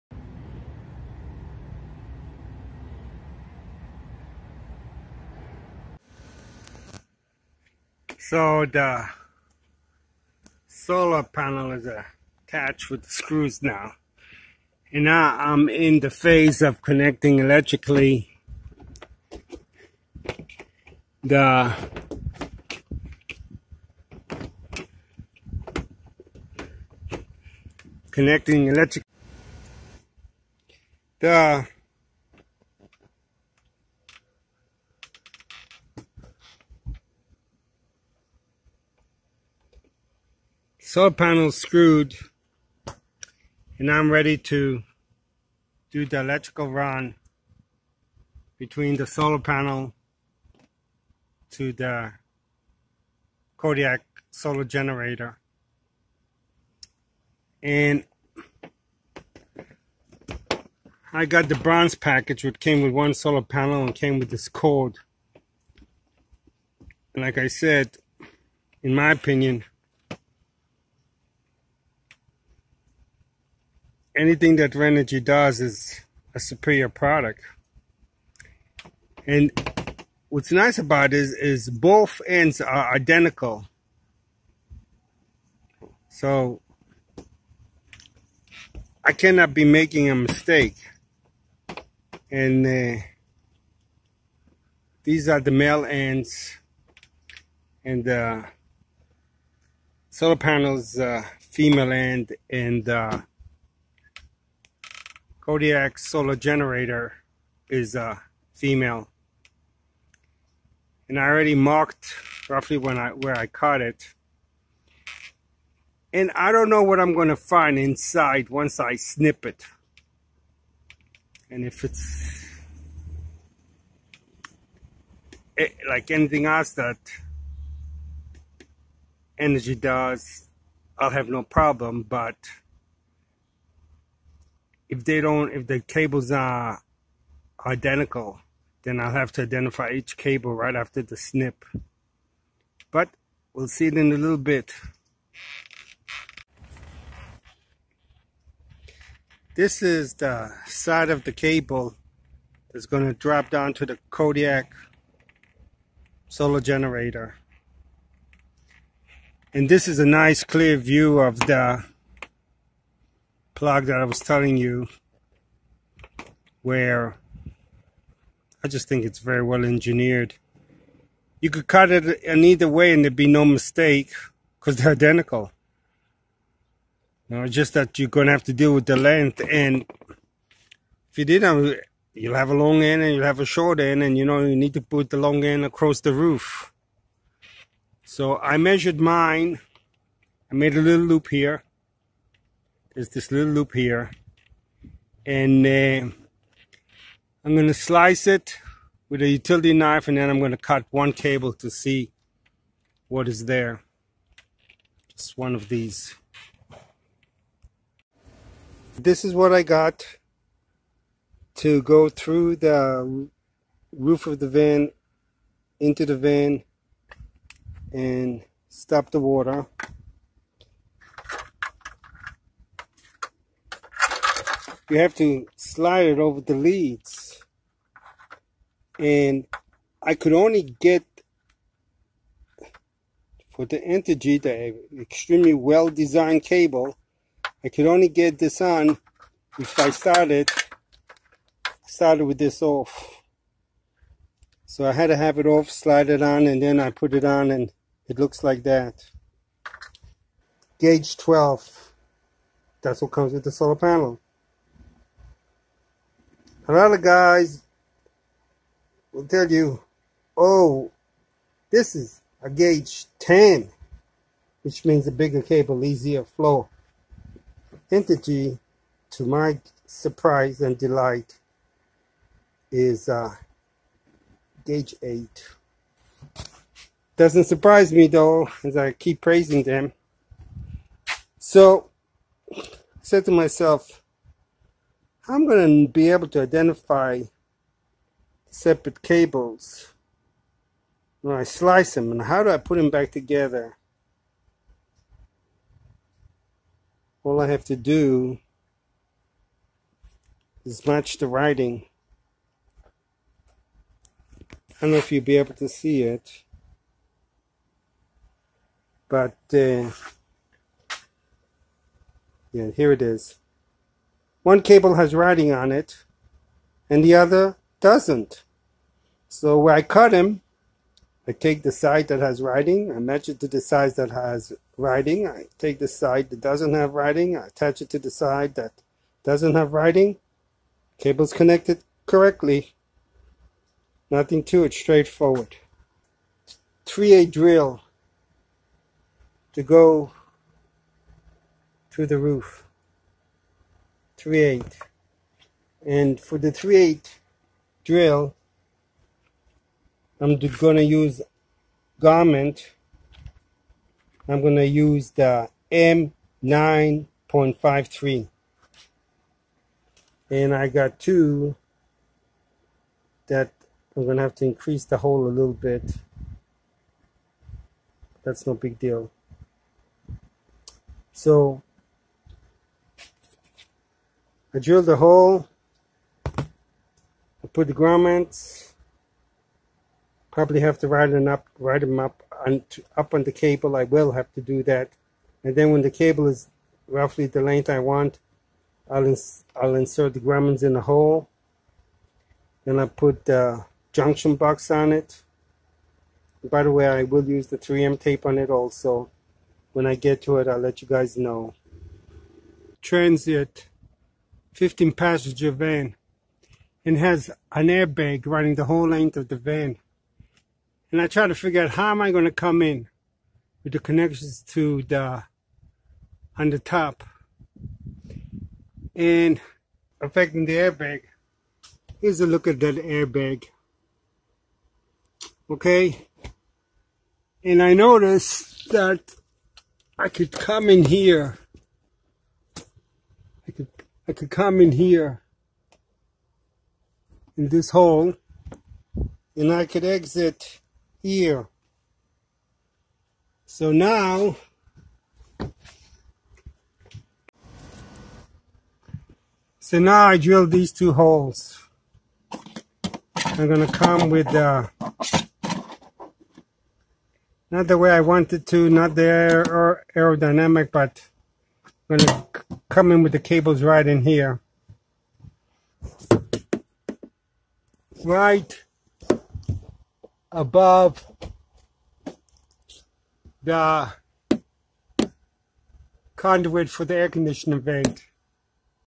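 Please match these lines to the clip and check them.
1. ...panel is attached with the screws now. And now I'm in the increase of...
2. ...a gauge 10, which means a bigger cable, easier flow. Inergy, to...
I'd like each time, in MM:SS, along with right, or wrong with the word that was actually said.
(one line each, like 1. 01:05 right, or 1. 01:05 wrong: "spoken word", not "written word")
1. 00:11 wrong: "phase", not "increase"
2. 04:22 right.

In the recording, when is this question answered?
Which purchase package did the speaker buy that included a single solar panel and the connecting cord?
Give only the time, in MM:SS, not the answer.
01:01.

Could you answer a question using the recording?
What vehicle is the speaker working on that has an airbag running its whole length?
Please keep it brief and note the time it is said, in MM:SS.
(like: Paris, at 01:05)
Transit 15 passenger van, at 06:42.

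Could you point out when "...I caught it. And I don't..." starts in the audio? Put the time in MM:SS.
01:53.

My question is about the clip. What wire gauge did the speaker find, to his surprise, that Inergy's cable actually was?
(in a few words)
8.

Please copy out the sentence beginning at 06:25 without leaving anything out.
And then when the cable is roughly the length I want, I'll ins I'll insert the grommets in the hole.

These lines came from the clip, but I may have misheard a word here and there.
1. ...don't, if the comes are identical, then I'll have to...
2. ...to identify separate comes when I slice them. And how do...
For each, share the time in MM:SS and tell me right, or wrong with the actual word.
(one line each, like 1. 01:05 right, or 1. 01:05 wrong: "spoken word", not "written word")
1. 02:15 wrong: "cables", not "comes"
2. 04:46 wrong: "cables", not "comes".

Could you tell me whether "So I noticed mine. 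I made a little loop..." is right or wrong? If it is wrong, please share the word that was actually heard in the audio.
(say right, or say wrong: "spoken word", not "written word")
wrong: "measured", not "noticed".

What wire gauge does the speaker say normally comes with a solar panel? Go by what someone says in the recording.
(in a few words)
12.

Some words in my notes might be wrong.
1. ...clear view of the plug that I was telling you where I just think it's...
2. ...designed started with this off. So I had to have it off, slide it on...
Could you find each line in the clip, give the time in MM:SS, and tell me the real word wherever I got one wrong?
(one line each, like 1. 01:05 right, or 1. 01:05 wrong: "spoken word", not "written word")
1. 02:40 right
2. 03:59 wrong: "started", not "designed".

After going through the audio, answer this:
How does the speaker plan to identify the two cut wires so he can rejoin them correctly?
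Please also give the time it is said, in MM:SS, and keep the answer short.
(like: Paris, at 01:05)
Match the writing, at 05:00.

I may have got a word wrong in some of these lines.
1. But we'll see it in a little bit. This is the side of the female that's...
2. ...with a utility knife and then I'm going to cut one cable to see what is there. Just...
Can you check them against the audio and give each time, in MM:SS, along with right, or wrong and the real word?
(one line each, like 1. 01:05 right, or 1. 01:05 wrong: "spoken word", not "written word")
1. 02:22 wrong: "cable", not "female"
2. 03:19 right.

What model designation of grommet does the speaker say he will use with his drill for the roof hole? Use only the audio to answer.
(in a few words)
M9.53.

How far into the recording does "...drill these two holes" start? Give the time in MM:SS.
07:30.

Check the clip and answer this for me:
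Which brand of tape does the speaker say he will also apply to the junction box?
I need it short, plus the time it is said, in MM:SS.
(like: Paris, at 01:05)
3M, at 06:37.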